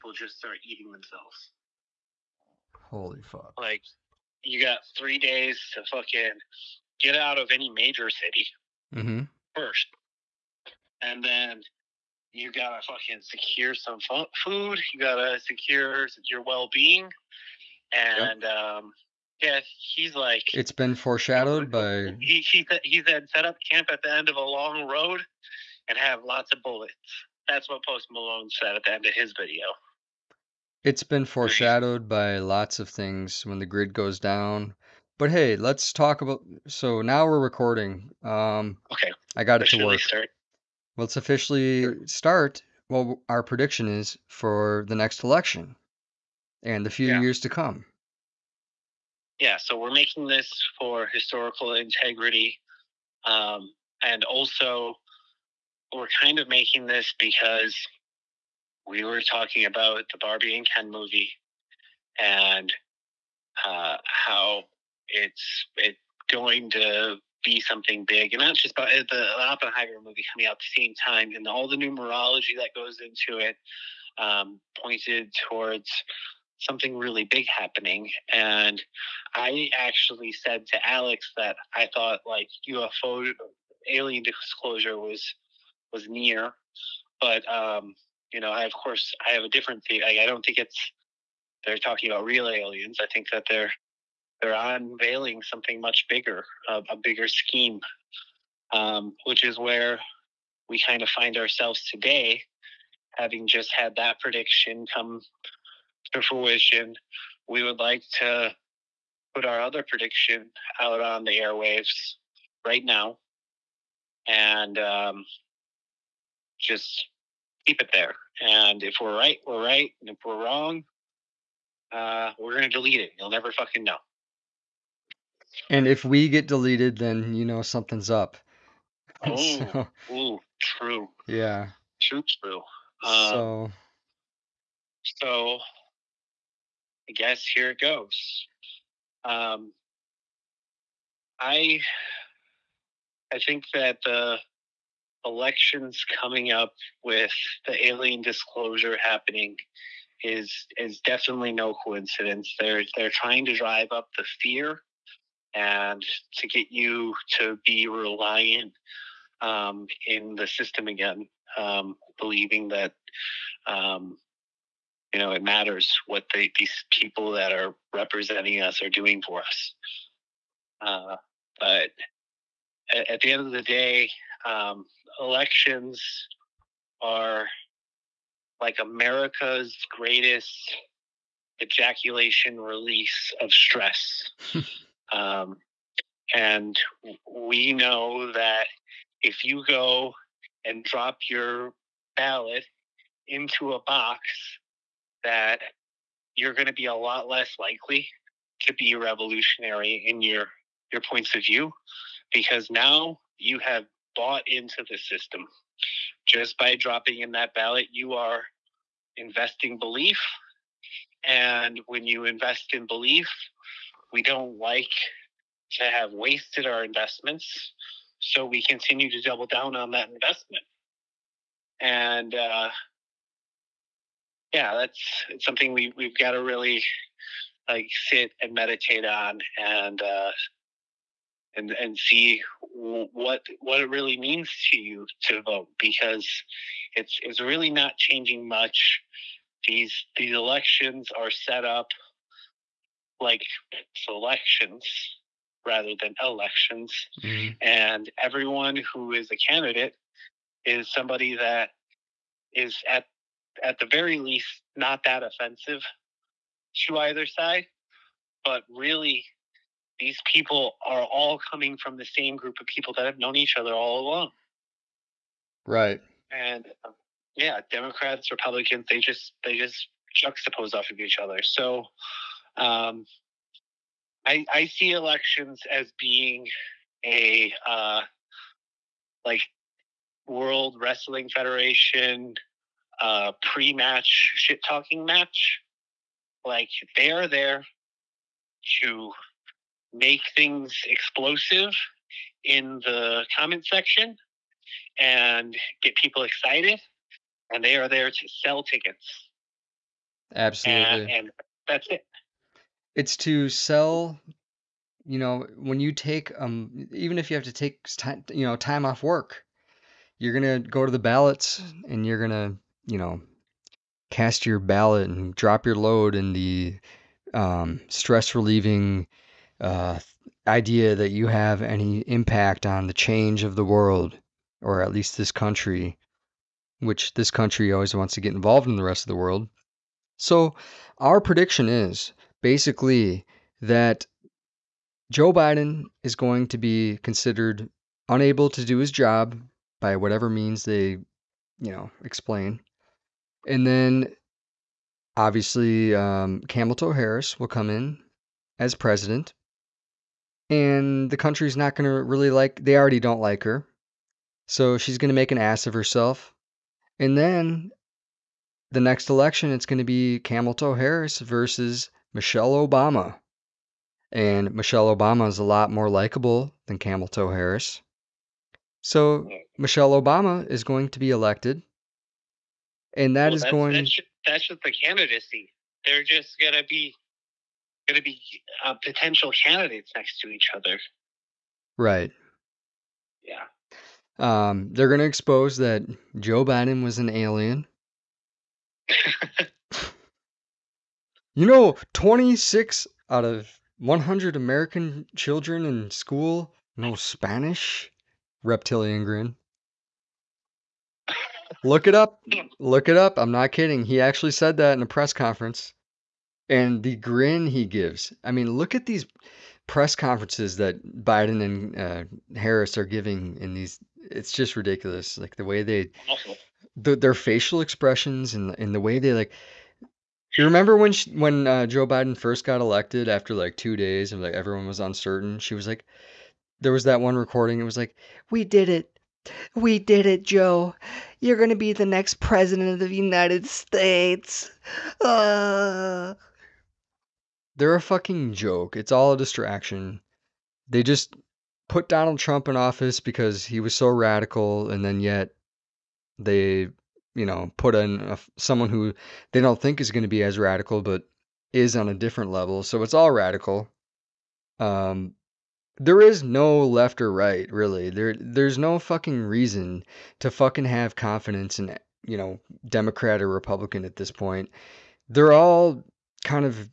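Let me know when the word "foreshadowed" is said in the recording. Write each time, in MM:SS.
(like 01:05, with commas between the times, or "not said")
00:20, 00:31.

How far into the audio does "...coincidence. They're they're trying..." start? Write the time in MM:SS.
02:31.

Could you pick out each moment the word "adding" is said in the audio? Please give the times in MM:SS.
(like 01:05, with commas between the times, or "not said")
not said.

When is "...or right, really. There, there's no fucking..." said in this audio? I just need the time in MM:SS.
07:37.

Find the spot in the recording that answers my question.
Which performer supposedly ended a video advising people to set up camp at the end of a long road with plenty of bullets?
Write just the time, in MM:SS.
00:27.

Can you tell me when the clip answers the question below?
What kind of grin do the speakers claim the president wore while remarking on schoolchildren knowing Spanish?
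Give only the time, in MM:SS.
06:38.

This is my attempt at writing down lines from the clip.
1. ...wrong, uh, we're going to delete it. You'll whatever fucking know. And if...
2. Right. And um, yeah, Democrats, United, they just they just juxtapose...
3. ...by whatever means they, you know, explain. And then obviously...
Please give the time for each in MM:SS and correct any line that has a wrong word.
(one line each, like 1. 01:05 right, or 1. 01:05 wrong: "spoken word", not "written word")
1. 02:00 wrong: "never", not "whatever"
2. 04:25 wrong: "Republicans", not "United"
3. 05:39 right.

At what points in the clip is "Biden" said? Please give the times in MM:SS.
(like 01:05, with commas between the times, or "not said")
05:35, 06:26, 06:51, 07:01.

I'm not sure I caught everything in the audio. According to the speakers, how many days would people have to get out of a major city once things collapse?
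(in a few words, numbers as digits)
3.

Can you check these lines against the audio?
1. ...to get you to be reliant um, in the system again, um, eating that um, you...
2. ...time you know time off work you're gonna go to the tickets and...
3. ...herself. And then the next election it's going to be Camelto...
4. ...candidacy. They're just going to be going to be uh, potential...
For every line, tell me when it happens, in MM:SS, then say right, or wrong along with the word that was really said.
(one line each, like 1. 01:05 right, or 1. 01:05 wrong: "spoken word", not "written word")
1. 02:36 wrong: "believing", not "eating"
2. 05:07 wrong: "ballots", not "tickets"
3. 05:55 right
4. 06:14 right.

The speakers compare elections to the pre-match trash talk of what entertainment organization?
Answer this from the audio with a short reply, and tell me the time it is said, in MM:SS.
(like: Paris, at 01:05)
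World Wrestling Federation, at 04:40.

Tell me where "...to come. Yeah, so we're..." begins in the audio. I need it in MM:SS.
00:47.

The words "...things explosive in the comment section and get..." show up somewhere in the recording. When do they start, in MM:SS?
04:50.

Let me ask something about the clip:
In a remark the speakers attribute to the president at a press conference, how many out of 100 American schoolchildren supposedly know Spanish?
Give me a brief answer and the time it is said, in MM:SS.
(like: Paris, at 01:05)
26, at 06:31.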